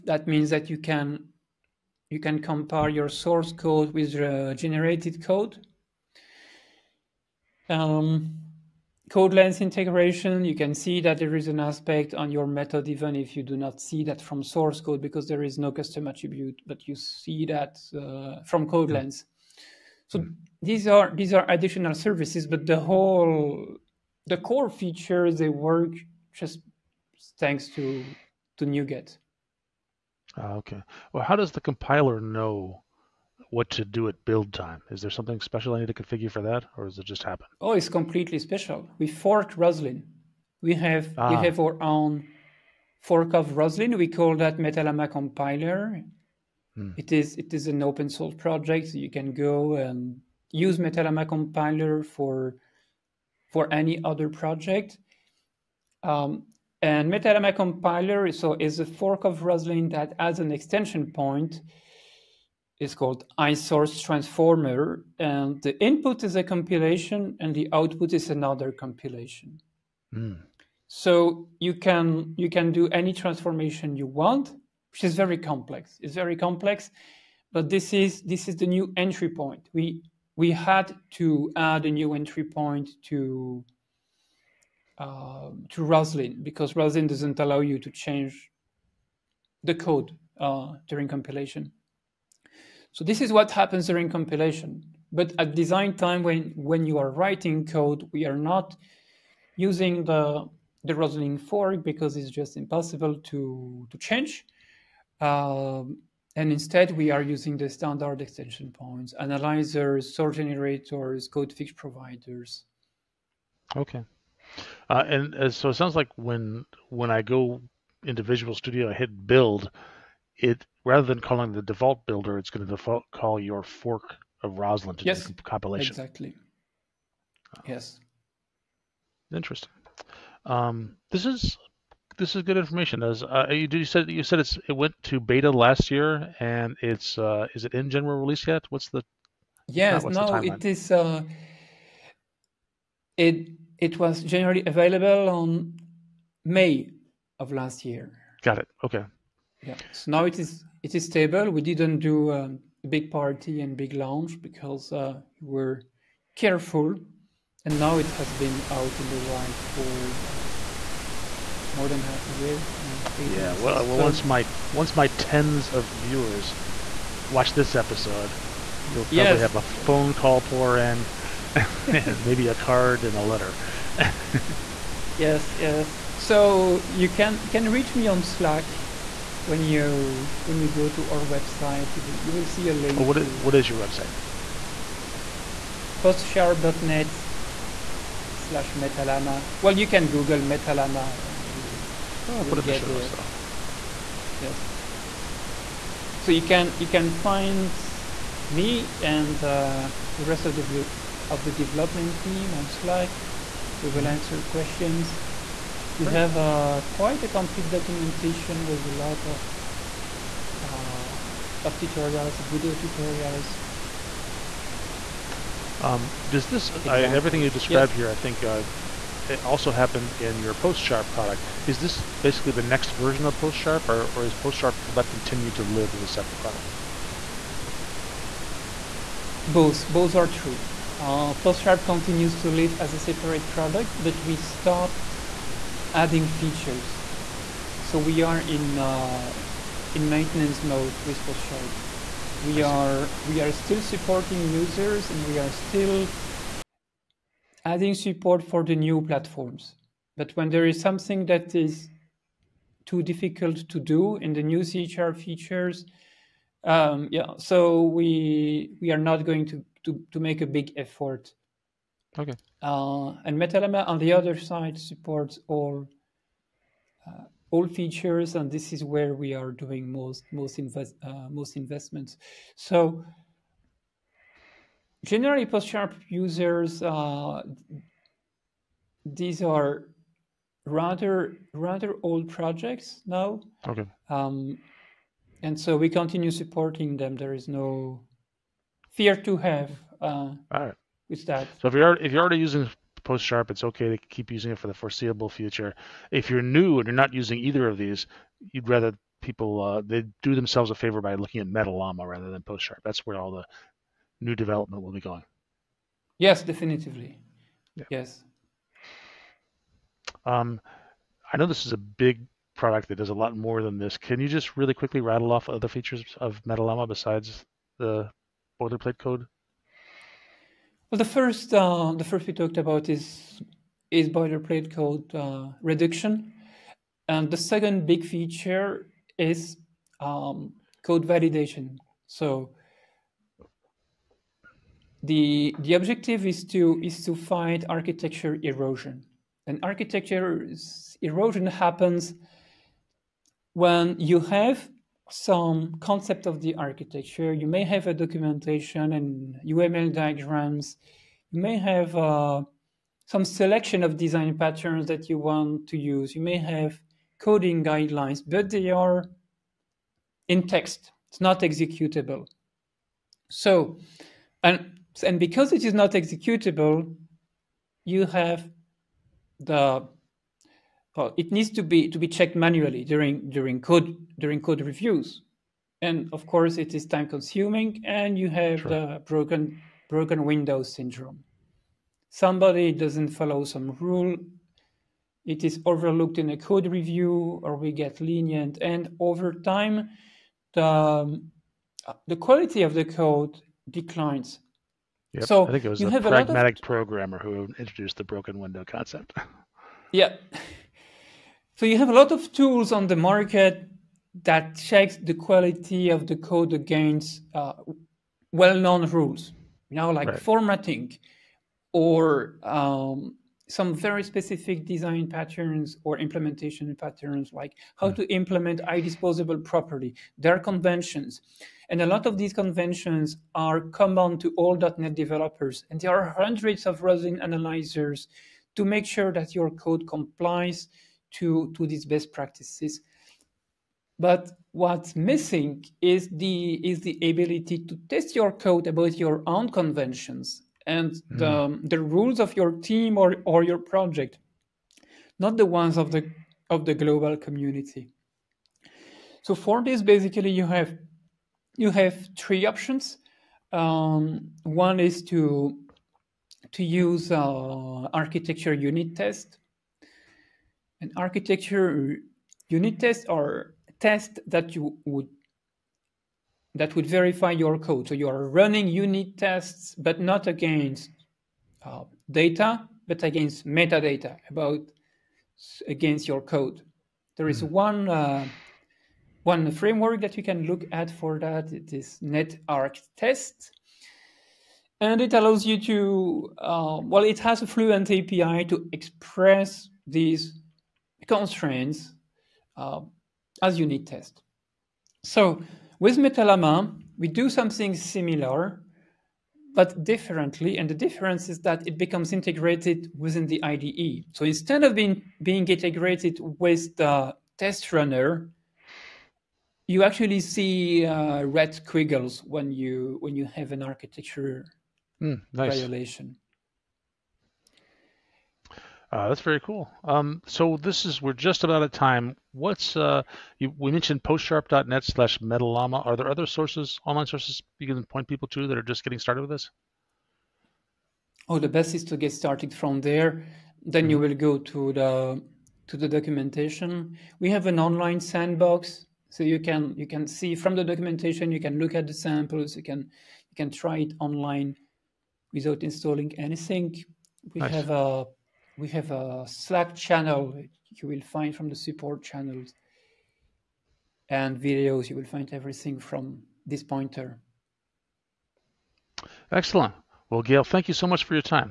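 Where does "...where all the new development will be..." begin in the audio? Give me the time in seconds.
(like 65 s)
303 s.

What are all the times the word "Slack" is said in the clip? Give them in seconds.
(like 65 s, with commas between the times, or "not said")
178 s, 202 s, 549 s.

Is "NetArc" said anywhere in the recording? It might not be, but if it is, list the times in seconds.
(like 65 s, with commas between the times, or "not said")
482 s.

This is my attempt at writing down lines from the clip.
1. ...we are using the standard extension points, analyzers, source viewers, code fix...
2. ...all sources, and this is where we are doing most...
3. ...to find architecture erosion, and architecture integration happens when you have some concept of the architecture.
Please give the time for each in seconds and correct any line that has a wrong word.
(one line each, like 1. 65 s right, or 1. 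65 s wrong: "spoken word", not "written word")
1. 106 s wrong: "generators", not "viewers"
2. 267 s wrong: "features", not "sources"
3. 337 s wrong: "erosion", not "integration".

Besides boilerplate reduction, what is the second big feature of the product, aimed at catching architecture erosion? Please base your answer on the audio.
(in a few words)
code validation.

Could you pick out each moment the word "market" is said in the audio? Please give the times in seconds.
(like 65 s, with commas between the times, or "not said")
402 s.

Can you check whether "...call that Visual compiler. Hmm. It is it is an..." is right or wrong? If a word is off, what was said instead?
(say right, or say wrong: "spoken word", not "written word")
wrong: "Metalama", not "Visual".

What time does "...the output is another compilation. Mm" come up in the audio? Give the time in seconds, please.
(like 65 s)
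67 s.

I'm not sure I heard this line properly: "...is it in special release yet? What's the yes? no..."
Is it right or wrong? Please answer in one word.
wrong.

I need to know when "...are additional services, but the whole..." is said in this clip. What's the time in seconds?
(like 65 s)
21 s.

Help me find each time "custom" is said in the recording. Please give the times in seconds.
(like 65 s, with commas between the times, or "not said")
15 s.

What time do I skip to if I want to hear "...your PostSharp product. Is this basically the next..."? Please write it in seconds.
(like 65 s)
220 s.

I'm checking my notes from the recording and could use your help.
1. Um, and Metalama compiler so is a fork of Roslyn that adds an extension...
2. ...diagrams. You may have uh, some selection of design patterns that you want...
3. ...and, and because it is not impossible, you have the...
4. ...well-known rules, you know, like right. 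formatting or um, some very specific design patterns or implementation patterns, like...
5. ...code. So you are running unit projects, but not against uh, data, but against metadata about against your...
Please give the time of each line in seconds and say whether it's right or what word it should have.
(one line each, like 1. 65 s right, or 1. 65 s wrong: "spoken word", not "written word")
1. 56 s right
2. 349 s right
3. 364 s wrong: "executable", not "impossible"
4. 408 s right
5. 467 s wrong: "tests", not "projects".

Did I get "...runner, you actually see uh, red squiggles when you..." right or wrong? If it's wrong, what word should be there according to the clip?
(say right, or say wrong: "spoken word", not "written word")
right.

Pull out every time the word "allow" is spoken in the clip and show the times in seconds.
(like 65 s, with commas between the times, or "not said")
87 s, 485 s.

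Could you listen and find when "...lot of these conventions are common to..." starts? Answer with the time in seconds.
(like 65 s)
421 s.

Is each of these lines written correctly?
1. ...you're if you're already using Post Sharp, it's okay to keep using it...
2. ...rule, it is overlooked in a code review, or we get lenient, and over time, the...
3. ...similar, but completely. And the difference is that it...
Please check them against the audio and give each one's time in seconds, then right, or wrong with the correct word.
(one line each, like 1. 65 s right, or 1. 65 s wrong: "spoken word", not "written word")
1. 291 s right
2. 383 s right
3. 497 s wrong: "differently", not "completely".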